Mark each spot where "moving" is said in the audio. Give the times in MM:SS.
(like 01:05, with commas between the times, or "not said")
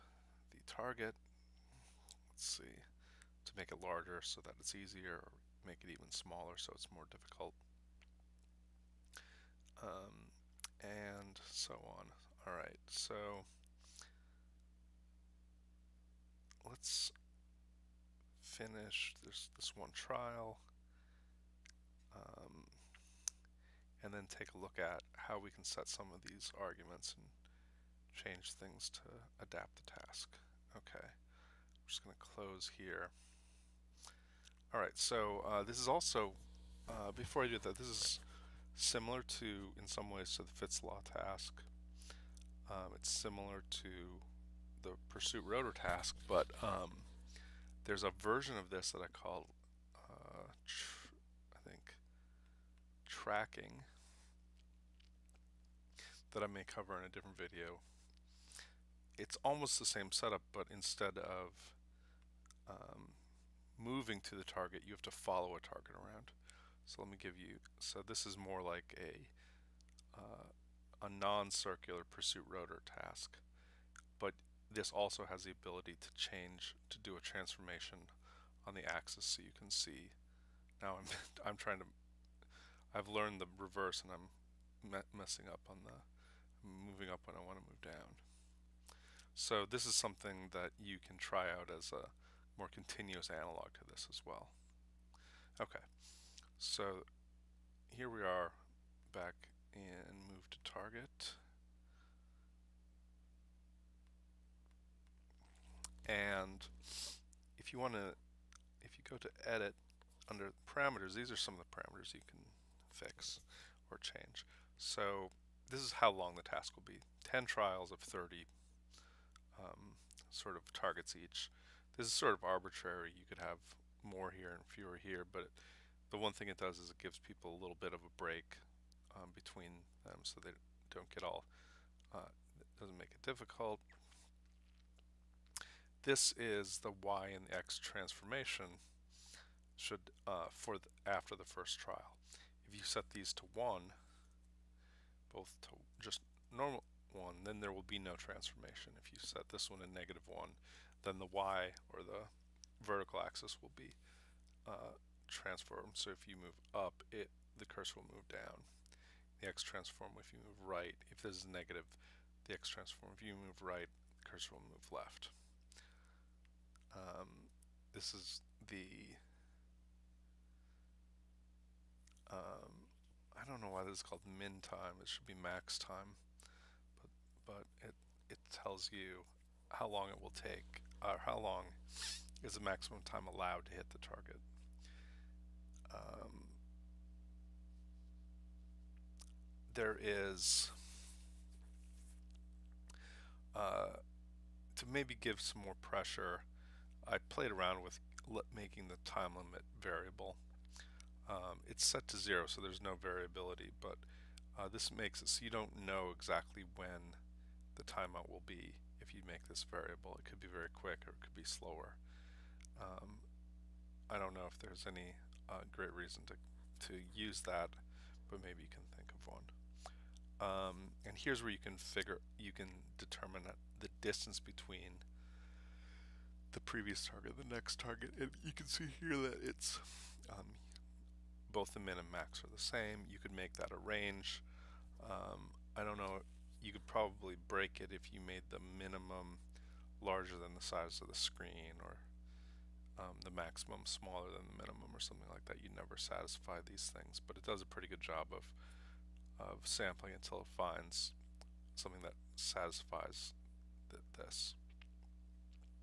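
01:03, 01:26.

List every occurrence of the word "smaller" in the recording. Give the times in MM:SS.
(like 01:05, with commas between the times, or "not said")
00:06, 04:03.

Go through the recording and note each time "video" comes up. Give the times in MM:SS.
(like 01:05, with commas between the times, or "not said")
00:57.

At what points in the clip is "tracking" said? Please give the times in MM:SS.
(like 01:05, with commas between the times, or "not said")
00:53.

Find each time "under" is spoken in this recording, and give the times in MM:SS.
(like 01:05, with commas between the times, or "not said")
01:50.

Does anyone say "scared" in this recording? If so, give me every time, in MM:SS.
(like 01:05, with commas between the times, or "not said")
not said.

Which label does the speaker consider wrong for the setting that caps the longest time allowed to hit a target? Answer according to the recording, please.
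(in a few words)
min time.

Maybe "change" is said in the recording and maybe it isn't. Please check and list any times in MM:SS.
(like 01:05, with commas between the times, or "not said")
00:28, 01:16, 01:53.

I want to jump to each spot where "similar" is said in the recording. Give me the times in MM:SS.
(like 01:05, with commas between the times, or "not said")
00:38, 00:43.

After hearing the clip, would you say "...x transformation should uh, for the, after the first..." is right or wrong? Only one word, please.
right.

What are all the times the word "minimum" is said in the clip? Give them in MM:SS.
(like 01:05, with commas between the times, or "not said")
03:58, 04:04.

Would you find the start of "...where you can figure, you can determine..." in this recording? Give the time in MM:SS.
03:41.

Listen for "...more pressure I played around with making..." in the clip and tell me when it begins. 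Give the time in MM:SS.
03:15.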